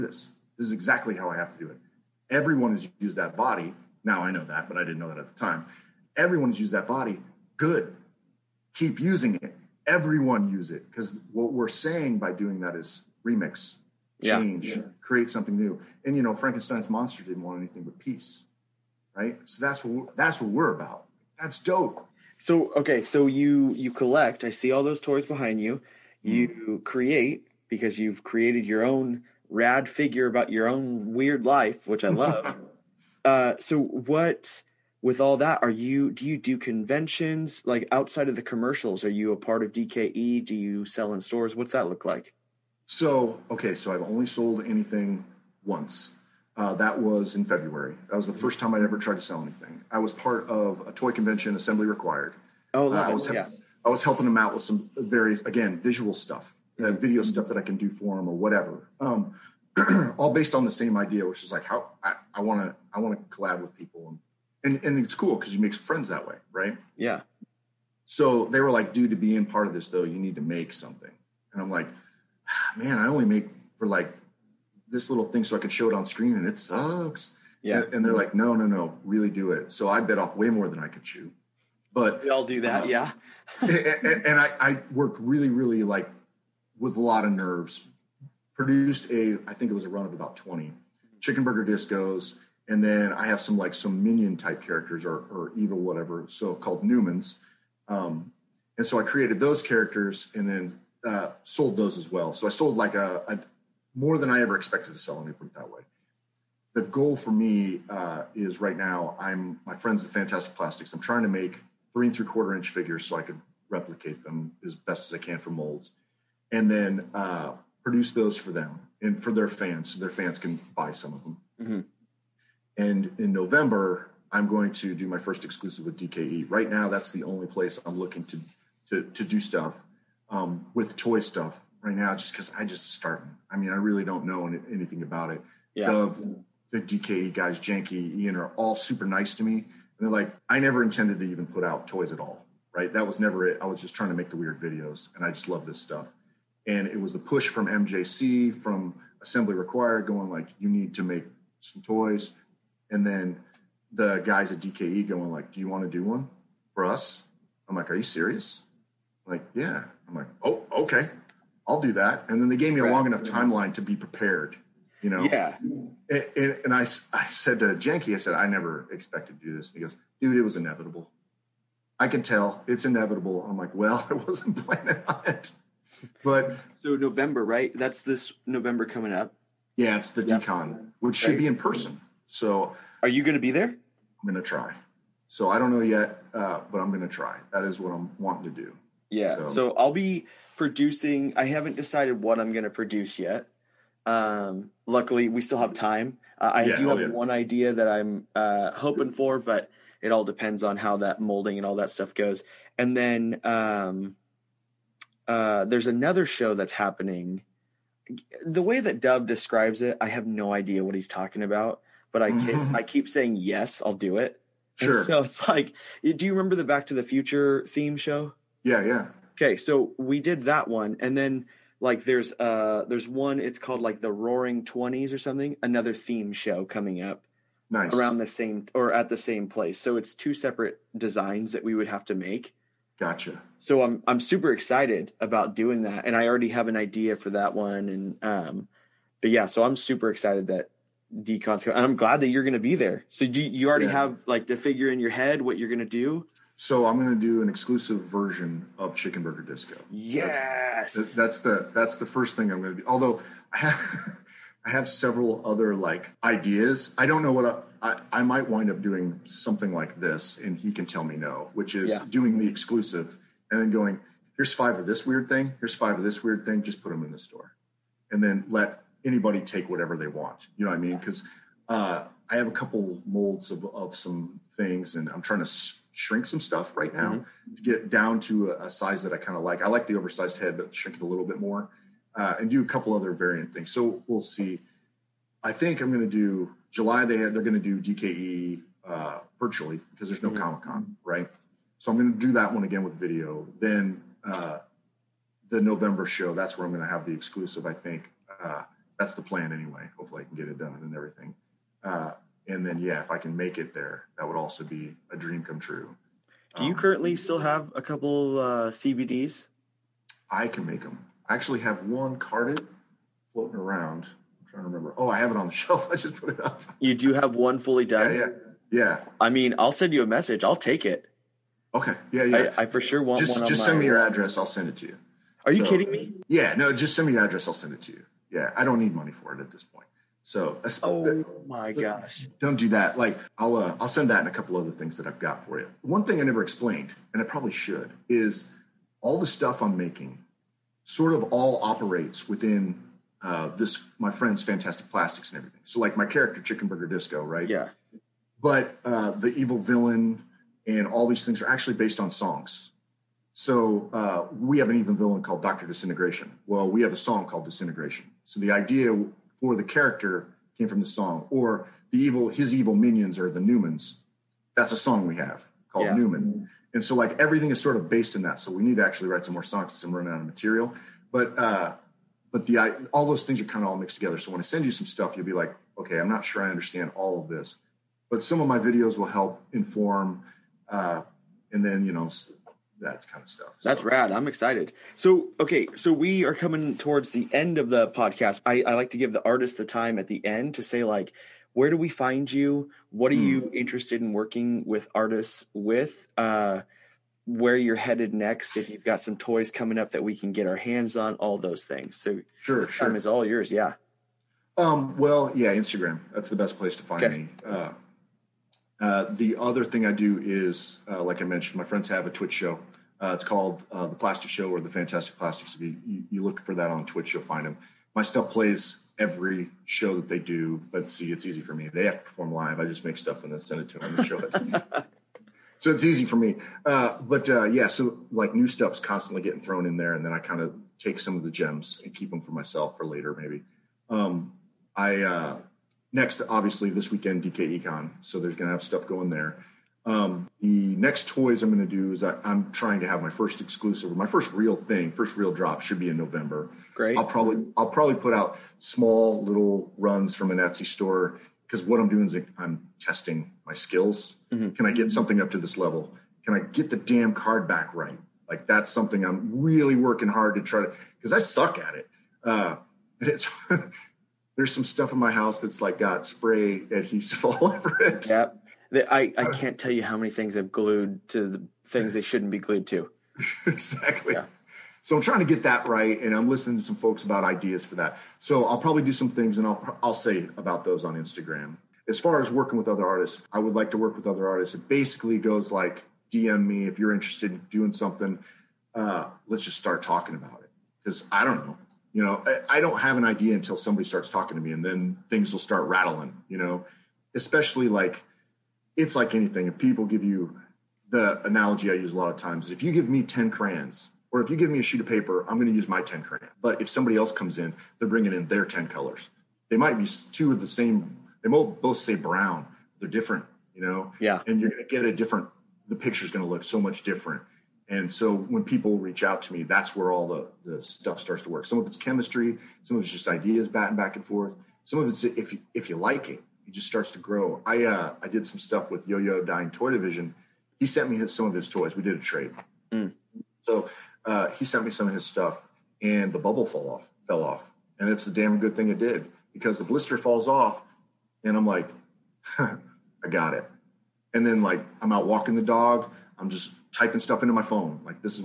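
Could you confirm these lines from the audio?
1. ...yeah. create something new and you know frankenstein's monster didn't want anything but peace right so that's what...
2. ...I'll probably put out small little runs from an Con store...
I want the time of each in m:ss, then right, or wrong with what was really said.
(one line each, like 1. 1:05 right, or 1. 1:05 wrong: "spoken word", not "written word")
1. 0:14 right
2. 7:27 wrong: "Etsy", not "Con".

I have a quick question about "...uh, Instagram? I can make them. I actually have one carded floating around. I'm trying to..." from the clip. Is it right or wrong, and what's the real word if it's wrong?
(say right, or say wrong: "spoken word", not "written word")
wrong: "CBDs", not "Instagram".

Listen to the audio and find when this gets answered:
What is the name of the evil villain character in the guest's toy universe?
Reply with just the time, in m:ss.
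5:55.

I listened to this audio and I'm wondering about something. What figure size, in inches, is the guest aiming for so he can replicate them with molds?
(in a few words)
3 3/4.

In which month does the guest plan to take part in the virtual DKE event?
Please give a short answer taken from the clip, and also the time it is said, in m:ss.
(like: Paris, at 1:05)
July, at 4:46.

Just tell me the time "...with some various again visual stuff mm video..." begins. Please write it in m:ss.
0:54.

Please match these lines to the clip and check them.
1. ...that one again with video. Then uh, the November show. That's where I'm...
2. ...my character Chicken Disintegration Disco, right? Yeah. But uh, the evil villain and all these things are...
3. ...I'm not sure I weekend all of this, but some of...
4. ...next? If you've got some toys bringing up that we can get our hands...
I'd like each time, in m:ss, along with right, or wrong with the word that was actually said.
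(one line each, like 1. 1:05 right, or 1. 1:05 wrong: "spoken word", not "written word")
1. 4:52 right
2. 5:45 wrong: "Burger", not "Disintegration"
3. 6:15 wrong: "understand", not "weekend"
4. 6:38 wrong: "coming", not "bringing".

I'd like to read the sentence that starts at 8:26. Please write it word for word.
But if somebody else comes in, they're bringing in their 10 colors.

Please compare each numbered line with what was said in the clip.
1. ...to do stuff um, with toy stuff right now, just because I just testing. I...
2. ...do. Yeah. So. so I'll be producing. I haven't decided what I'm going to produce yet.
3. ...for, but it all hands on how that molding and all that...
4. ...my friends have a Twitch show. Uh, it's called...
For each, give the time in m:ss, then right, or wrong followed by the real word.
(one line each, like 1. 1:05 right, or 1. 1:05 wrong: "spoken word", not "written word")
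1. 2:09 wrong: "starting", not "testing"
2. 3:08 right
3. 3:19 wrong: "depends", not "hands"
4. 6:51 right.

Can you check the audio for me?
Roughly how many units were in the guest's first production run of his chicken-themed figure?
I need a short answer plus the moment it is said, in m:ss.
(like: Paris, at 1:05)
20, at 1:30.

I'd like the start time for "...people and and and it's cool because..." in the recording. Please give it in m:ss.
1:03.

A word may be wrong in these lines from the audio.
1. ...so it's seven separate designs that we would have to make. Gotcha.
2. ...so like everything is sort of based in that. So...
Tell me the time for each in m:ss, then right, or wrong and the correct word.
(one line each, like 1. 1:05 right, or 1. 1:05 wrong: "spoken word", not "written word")
1. 3:49 wrong: "two", not "seven"
2. 6:06 right.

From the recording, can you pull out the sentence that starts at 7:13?
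Um, I uh, next, obviously, this weekend DKE Con, so there's going to have stuff going there.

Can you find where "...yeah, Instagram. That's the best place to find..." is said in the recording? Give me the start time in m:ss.
6:45.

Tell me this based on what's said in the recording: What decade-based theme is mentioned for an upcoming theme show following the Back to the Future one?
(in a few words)
Roaring Twenties.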